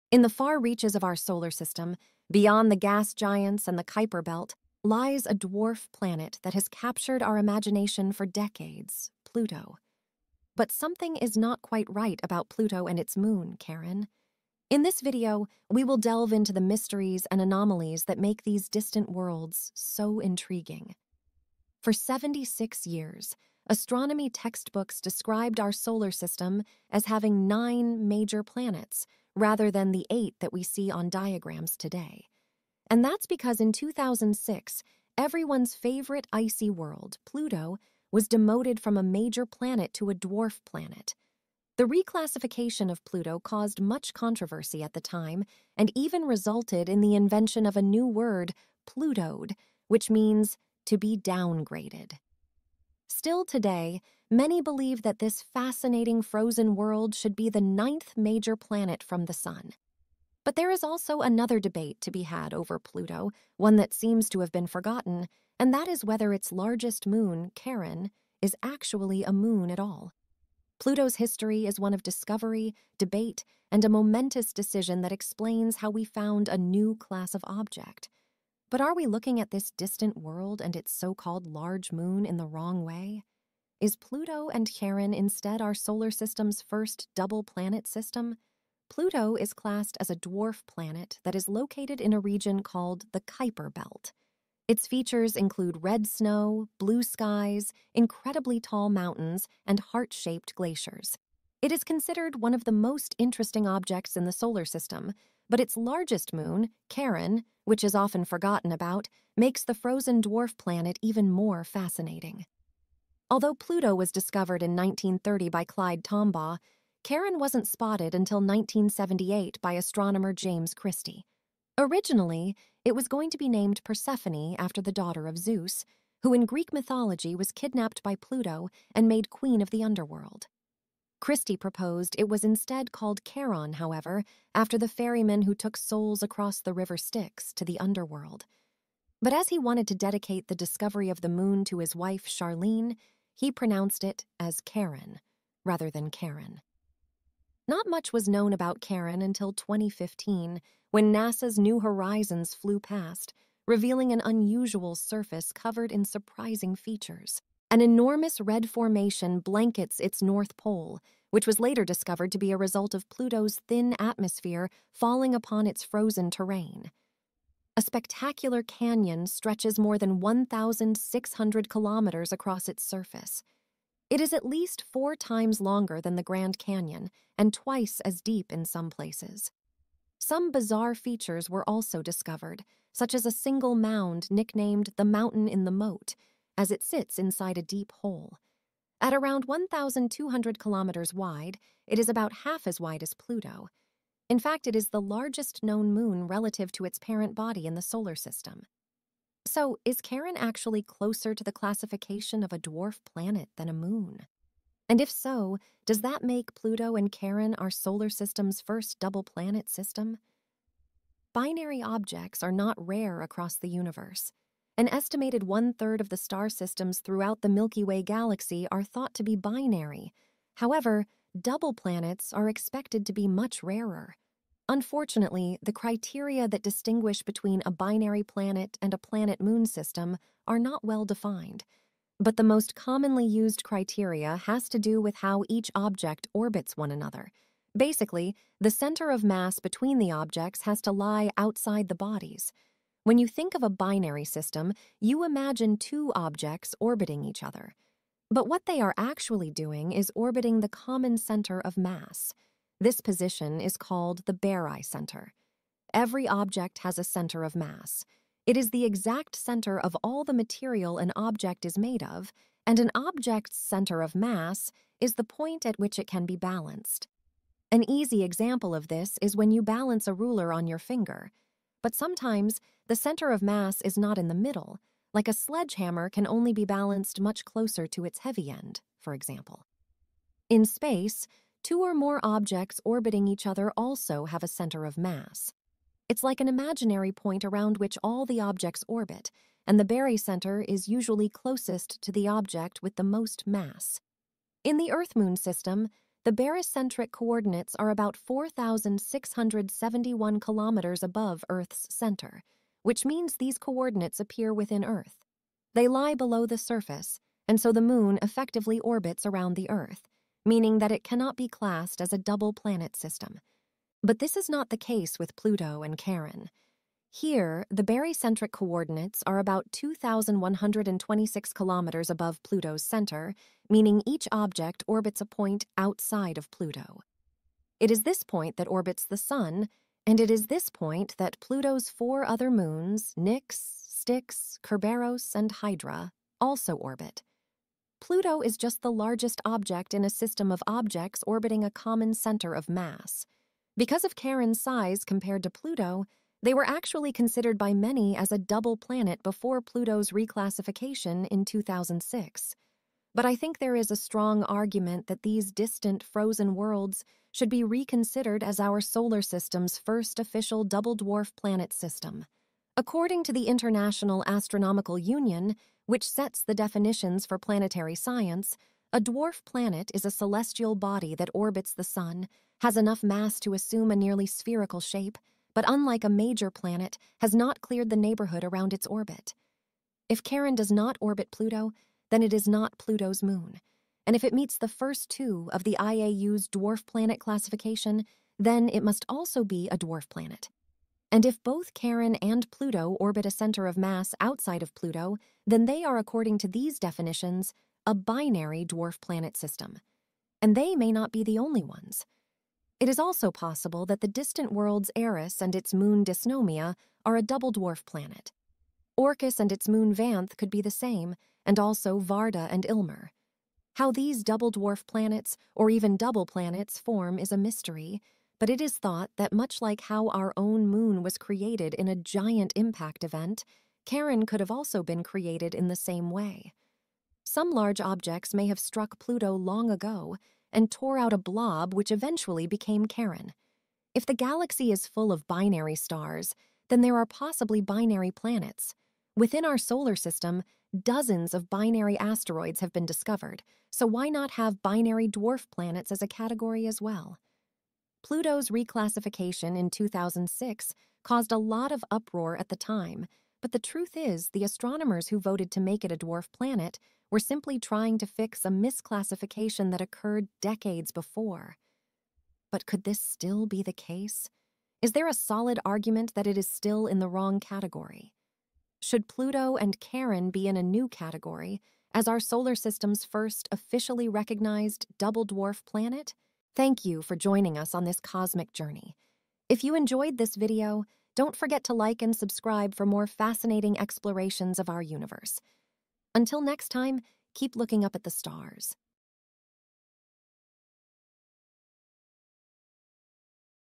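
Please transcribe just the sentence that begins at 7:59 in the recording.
If you enjoyed this video, don't forget to like and subscribe for more fascinating explorations of our universe.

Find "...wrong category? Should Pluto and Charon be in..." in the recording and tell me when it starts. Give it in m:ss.
7:47.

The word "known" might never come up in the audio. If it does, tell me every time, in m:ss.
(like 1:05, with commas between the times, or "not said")
2:28, 3:15.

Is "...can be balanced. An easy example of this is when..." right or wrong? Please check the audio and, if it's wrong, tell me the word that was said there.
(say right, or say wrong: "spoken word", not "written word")
right.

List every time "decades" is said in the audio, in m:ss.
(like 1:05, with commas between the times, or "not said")
0:08, 7:40.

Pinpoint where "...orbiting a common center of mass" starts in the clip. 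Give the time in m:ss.
5:41.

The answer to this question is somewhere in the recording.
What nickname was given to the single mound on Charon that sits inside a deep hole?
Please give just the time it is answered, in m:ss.
3:05.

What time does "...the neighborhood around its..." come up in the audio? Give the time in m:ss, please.
6:17.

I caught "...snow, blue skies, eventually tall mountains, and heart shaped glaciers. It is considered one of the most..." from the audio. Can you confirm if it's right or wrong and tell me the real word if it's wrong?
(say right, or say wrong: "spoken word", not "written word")
wrong: "incredibly", not "eventually".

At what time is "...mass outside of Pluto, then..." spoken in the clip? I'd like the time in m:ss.
6:33.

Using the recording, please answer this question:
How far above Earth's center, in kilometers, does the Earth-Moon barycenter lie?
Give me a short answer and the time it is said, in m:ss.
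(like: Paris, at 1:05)
4,671 km, at 4:58.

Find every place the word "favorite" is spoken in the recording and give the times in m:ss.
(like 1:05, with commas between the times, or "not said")
0:35.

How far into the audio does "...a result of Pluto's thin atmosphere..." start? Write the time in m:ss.
2:42.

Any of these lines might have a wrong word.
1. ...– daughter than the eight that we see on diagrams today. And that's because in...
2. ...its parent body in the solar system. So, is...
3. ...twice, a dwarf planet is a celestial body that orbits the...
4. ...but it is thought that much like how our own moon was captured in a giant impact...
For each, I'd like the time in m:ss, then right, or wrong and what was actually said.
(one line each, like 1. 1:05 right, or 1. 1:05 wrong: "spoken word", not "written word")
1. 0:29 wrong: "rather", not "daughter"
2. 3:16 right
3. 6:07 wrong: "science", not "twice"
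4. 6:58 wrong: "created", not "captured".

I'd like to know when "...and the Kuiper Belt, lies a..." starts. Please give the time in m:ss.
0:03.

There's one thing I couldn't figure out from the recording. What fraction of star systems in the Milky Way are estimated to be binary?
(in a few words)
One third.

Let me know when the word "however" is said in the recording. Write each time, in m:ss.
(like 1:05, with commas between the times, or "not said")
2:13, 3:40.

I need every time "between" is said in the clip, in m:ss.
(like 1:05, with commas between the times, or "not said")
3:47, 3:59.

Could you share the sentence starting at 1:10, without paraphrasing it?
Pluto's history is one of discovery, debate, and a momentous decision that explains how we found a new class of object.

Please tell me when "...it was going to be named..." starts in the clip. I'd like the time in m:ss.
2:02.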